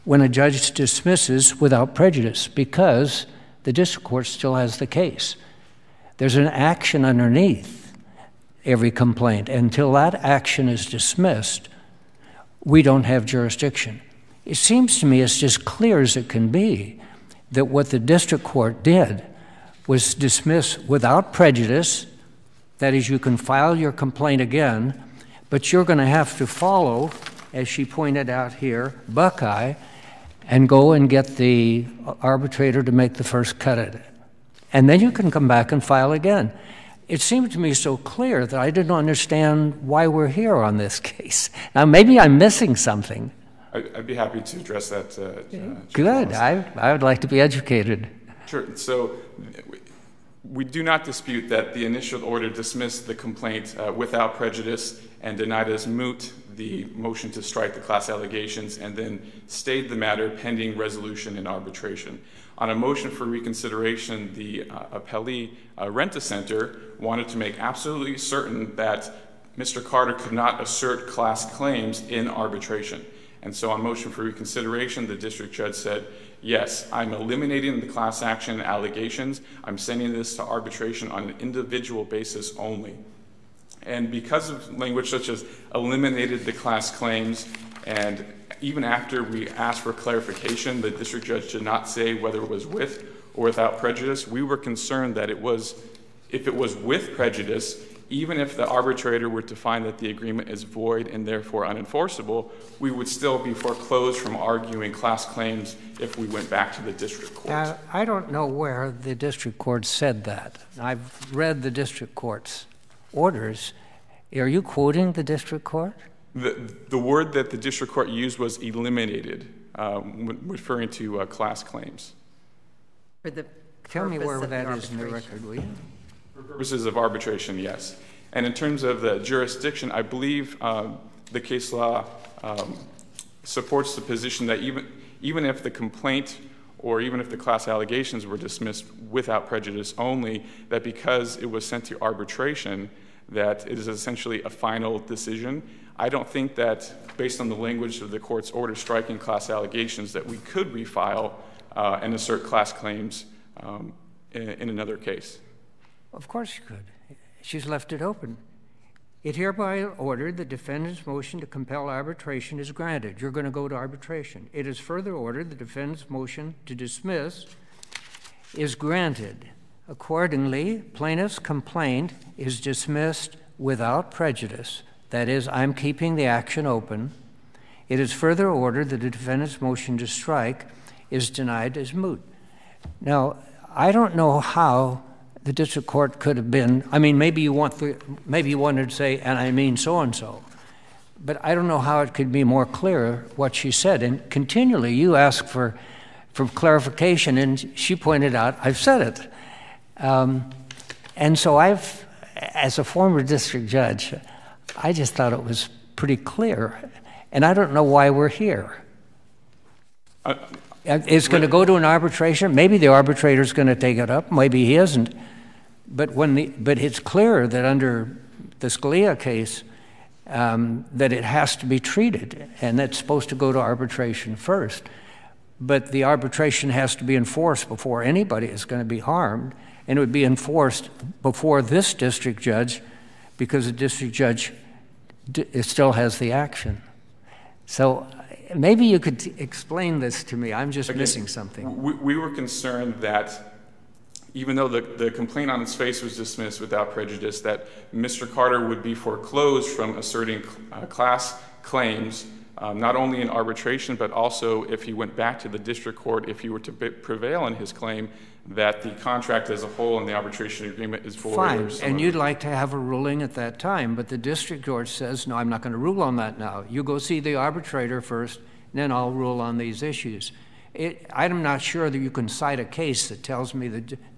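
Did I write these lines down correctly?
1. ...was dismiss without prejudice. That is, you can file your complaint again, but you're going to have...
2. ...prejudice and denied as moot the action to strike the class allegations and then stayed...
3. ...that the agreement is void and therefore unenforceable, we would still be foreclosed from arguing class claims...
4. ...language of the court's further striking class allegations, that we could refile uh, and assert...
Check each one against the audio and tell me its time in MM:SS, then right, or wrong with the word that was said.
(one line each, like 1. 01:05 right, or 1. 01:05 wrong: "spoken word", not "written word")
1. 00:19 right
2. 00:54 wrong: "motion", not "action"
3. 01:39 right
4. 02:27 wrong: "order", not "further".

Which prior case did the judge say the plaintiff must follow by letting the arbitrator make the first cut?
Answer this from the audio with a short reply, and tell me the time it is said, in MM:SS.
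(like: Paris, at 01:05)
Buckeye, at 00:29.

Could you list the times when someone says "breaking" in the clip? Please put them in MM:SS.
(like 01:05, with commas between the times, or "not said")
not said.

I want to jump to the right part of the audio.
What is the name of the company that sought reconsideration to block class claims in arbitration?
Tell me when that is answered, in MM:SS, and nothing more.
01:05.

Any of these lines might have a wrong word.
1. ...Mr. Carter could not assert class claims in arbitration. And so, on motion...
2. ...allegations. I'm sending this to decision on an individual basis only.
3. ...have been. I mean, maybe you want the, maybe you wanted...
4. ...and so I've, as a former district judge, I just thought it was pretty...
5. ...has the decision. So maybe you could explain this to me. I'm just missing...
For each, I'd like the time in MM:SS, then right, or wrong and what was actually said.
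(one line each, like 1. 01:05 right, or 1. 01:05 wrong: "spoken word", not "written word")
1. 01:09 right
2. 01:18 wrong: "arbitration", not "decision"
3. 03:06 right
4. 03:21 right
5. 03:55 wrong: "action", not "decision".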